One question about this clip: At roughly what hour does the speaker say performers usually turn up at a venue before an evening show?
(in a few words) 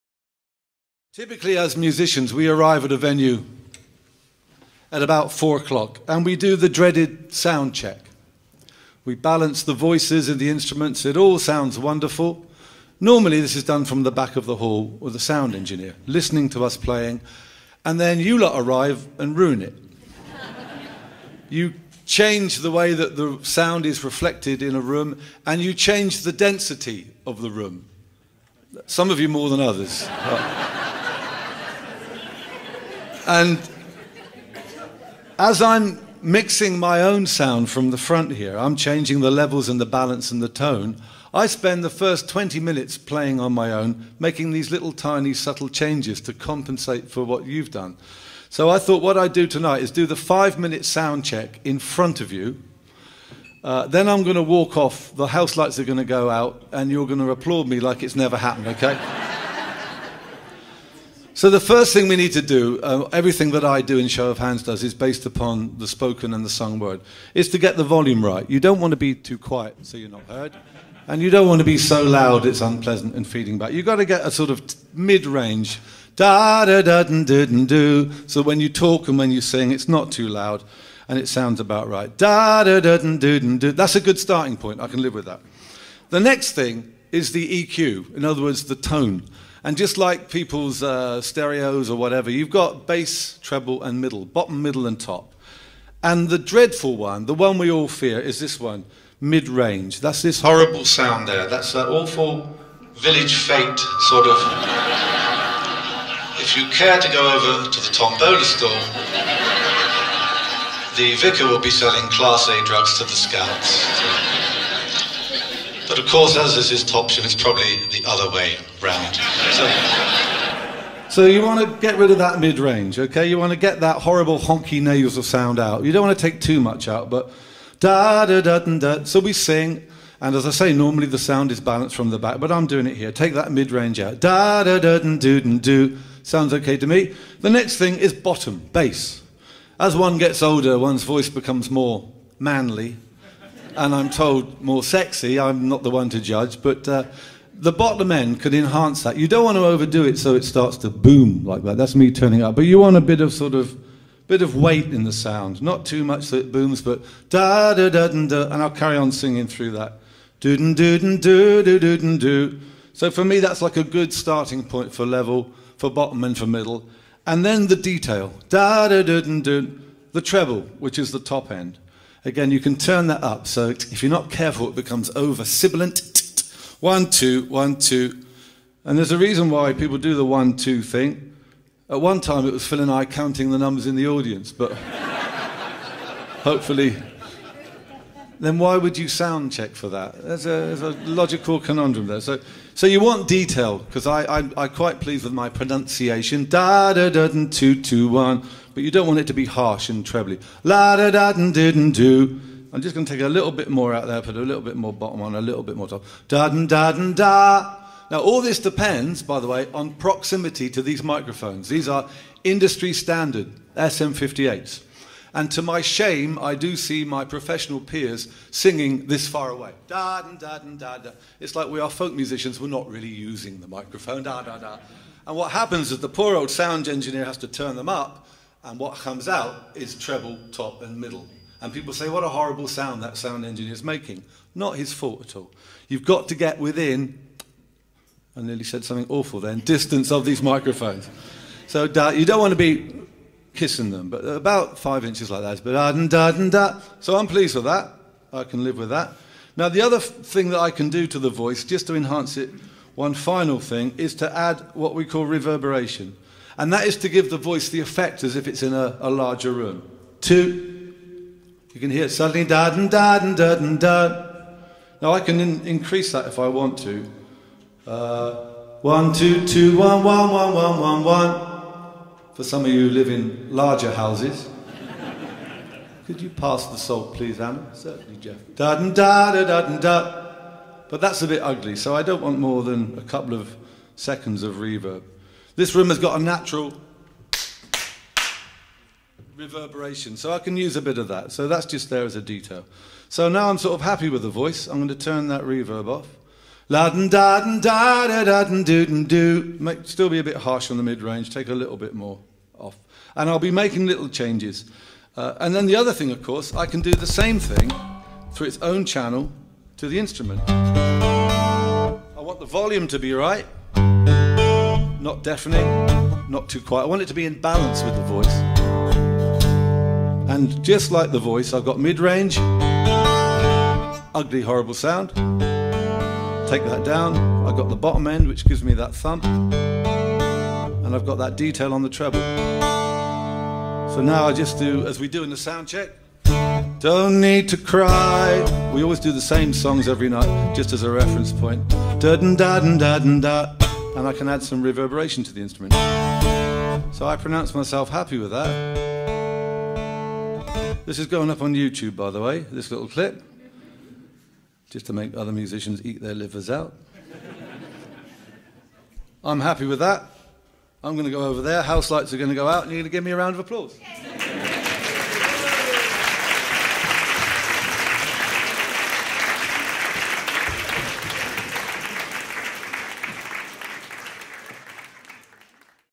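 4 o'clock.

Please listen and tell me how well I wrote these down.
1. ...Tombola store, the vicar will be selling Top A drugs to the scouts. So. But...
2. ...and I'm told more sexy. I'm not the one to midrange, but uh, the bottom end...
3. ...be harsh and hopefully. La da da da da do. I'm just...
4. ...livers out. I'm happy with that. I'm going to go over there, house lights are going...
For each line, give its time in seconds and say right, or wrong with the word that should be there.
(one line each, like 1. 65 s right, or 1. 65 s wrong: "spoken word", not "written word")
1. 107 s wrong: "Class", not "Top"
2. 143 s wrong: "judge", not "midrange"
3. 199 s wrong: "trebly", not "hopefully"
4. 356 s right.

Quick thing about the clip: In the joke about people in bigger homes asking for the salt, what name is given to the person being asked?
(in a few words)
Anna.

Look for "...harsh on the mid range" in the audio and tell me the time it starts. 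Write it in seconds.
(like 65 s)
300 s.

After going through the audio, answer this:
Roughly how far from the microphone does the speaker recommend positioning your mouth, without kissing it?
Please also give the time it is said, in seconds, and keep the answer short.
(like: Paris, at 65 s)
5 inches, at 244 s.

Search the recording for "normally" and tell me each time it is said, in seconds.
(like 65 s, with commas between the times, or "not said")
13 s, 130 s.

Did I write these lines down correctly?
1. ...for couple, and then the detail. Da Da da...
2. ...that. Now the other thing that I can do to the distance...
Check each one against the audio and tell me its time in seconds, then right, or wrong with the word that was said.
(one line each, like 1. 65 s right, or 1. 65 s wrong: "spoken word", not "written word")
1. 166 s wrong: "middle", not "couple"
2. 248 s wrong: "voice", not "distance".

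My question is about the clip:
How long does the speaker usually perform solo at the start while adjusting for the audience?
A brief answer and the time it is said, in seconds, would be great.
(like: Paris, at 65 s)
20 minutes, at 42 s.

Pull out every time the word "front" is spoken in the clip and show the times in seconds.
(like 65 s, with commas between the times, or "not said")
37 s, 51 s.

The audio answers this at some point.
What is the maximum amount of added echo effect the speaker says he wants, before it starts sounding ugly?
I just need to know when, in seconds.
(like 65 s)
282 s.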